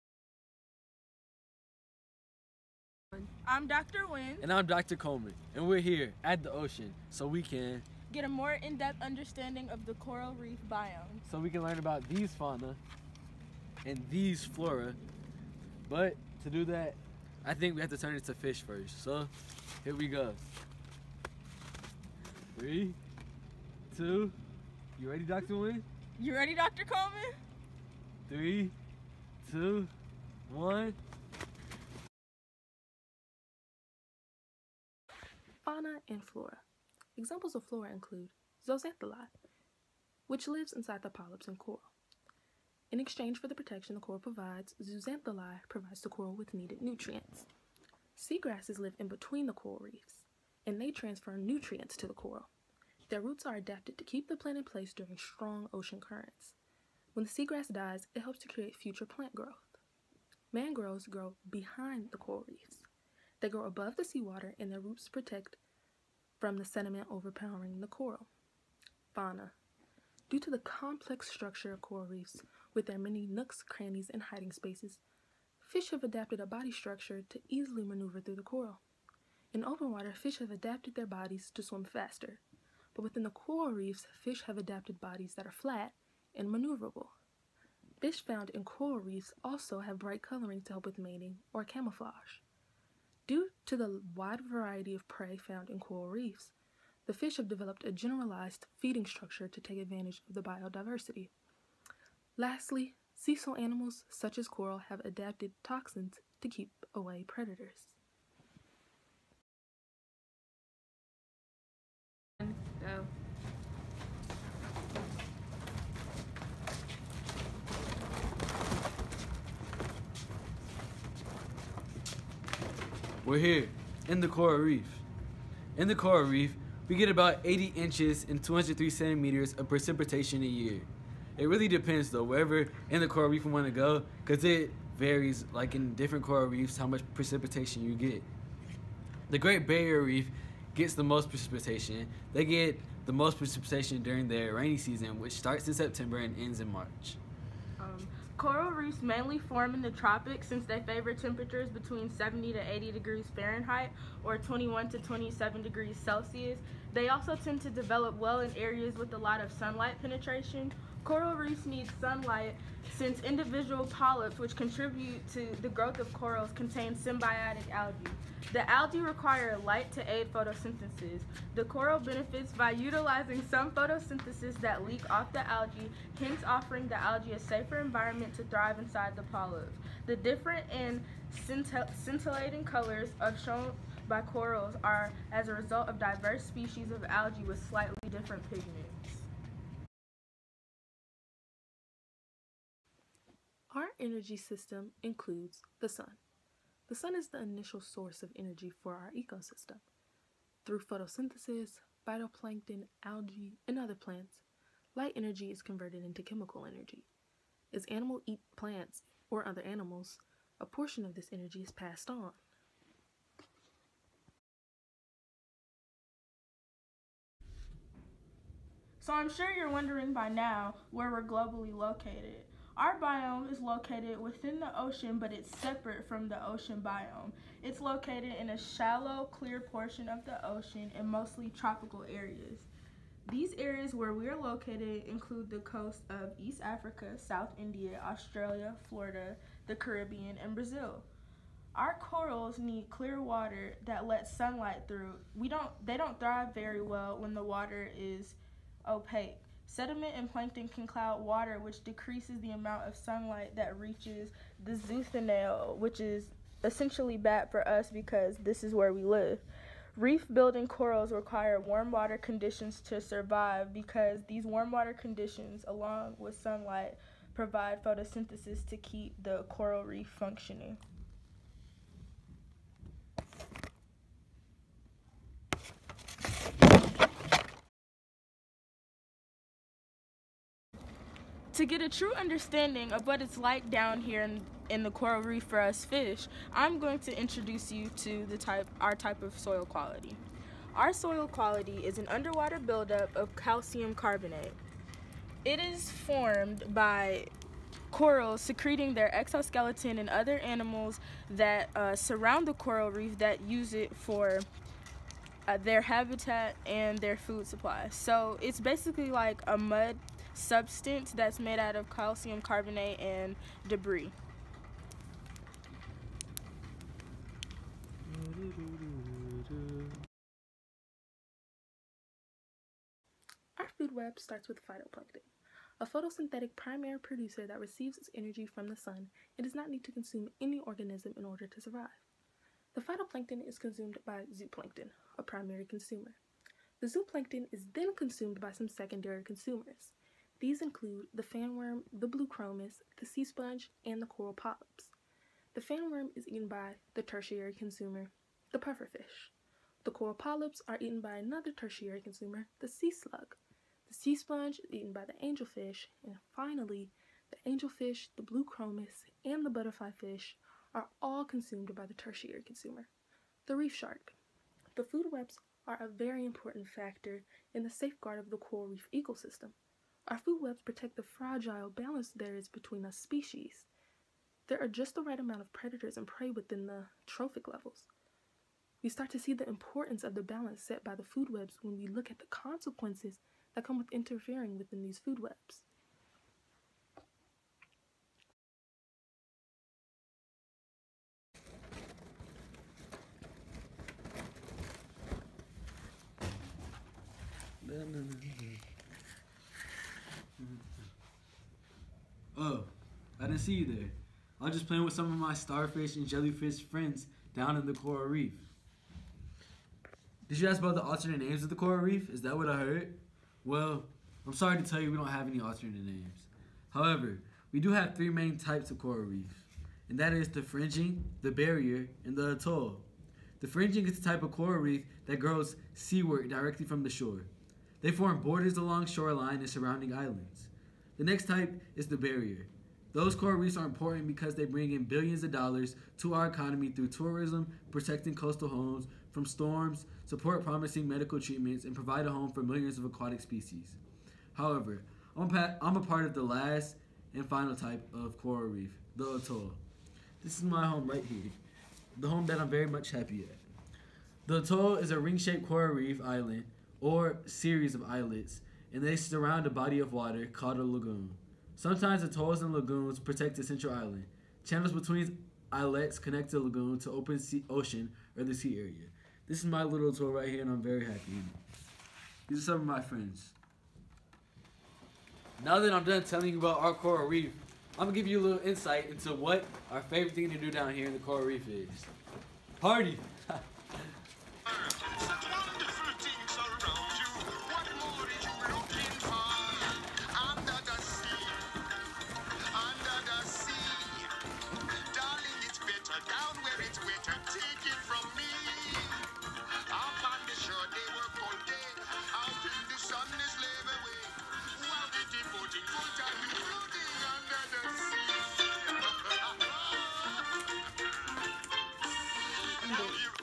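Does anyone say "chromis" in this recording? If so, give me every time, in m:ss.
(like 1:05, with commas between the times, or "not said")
5:42, 5:58.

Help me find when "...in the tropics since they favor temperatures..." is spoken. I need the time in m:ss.
2:29.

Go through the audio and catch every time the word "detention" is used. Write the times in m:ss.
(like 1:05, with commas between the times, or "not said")
not said.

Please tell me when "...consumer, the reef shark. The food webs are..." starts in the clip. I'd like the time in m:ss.
6:02.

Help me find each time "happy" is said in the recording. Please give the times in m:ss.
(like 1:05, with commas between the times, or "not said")
7:32, 7:50.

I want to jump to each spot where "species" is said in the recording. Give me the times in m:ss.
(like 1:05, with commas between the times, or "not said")
3:06, 6:12, 7:23.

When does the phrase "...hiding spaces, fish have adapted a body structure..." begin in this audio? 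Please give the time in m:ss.
1:14.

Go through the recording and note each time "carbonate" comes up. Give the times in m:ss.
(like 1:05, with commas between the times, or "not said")
4:53, 5:12.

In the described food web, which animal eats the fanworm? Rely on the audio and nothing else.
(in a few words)
pufferfish.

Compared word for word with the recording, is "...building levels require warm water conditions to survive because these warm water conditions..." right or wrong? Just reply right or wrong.
wrong.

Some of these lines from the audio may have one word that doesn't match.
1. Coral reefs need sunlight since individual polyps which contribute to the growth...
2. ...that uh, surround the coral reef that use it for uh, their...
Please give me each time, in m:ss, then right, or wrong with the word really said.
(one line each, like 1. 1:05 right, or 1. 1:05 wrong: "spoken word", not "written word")
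1. 2:41 right
2. 5:01 right.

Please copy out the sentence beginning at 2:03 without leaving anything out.
We're here in the coral reef.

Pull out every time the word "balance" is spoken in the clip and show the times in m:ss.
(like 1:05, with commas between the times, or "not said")
6:11, 6:20.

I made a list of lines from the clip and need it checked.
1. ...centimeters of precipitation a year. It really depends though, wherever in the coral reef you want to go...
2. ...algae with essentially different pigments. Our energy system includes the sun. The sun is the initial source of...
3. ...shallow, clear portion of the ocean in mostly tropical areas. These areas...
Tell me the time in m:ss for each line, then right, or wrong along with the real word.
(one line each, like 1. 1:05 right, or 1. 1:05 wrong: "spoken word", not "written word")
1. 2:08 right
2. 3:07 wrong: "slightly", not "essentially"
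3. 3:48 right.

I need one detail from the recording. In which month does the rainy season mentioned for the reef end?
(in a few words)
March.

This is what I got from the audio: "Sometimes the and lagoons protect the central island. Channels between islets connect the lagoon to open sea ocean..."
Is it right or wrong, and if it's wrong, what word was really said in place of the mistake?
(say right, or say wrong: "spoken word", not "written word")
right.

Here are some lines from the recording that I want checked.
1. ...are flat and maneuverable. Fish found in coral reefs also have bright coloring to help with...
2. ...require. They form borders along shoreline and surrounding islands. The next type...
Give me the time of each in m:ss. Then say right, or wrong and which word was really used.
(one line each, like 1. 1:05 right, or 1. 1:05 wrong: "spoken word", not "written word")
1. 1:25 right
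2. 7:06 wrong: "shore", not "require".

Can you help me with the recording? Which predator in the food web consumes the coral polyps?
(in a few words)
sea slug.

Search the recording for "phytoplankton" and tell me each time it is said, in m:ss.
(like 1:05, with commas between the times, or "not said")
3:22, 5:24, 5:32.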